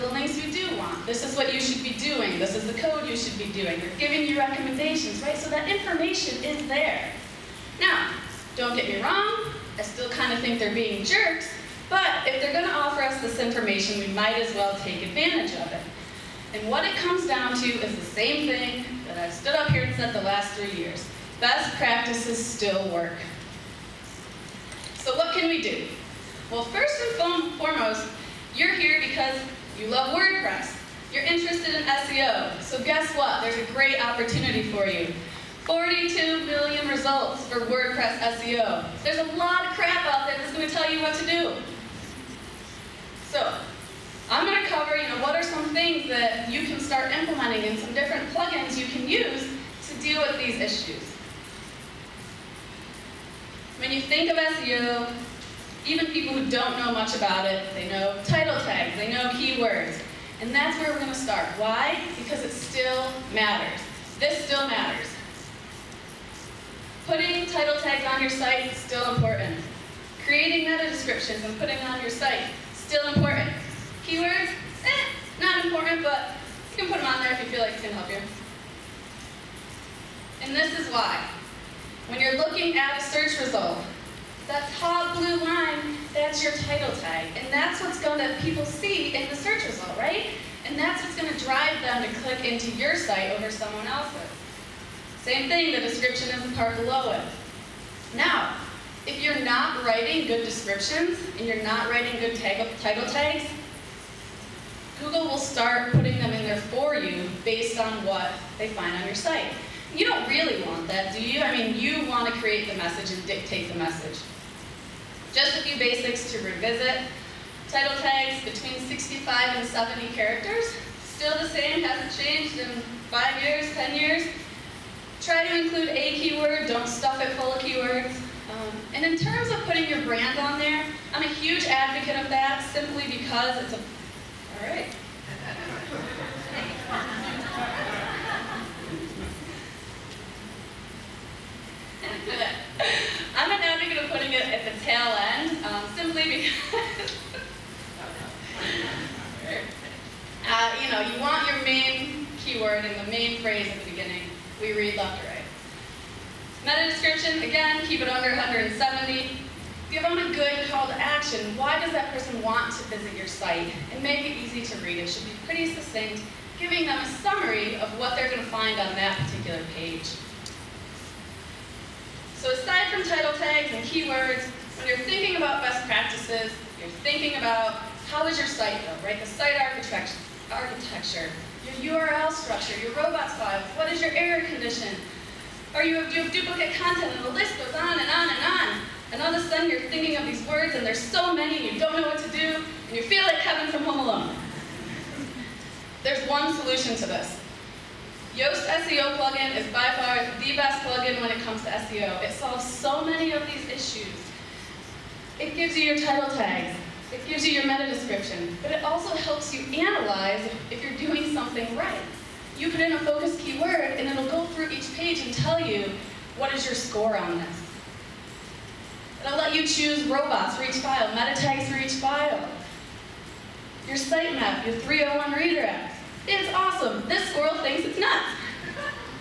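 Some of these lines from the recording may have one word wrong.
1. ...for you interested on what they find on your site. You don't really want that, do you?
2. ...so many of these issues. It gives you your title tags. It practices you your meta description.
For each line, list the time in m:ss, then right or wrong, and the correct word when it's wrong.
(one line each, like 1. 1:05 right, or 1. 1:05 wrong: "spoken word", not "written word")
1. 1:46 wrong: "based", not "interested"
2. 3:22 wrong: "gives", not "practices".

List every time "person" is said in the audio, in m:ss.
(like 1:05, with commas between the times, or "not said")
2:42.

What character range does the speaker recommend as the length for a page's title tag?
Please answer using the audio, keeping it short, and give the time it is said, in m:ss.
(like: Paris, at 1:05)
65 to 70, at 1:58.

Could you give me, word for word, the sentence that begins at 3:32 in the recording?
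You put in a focus keyword, and it'll go through each page and tell you what is your score on this.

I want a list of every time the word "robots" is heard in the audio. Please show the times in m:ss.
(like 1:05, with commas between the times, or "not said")
3:02, 3:40.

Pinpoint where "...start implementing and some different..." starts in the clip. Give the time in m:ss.
0:46.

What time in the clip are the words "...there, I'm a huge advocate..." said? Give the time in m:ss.
2:10.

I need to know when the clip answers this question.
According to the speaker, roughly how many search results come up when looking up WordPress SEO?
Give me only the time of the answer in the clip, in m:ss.
0:35.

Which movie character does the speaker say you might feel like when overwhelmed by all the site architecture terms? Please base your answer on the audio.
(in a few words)
Kevin.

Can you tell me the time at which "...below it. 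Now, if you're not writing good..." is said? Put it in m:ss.
1:36.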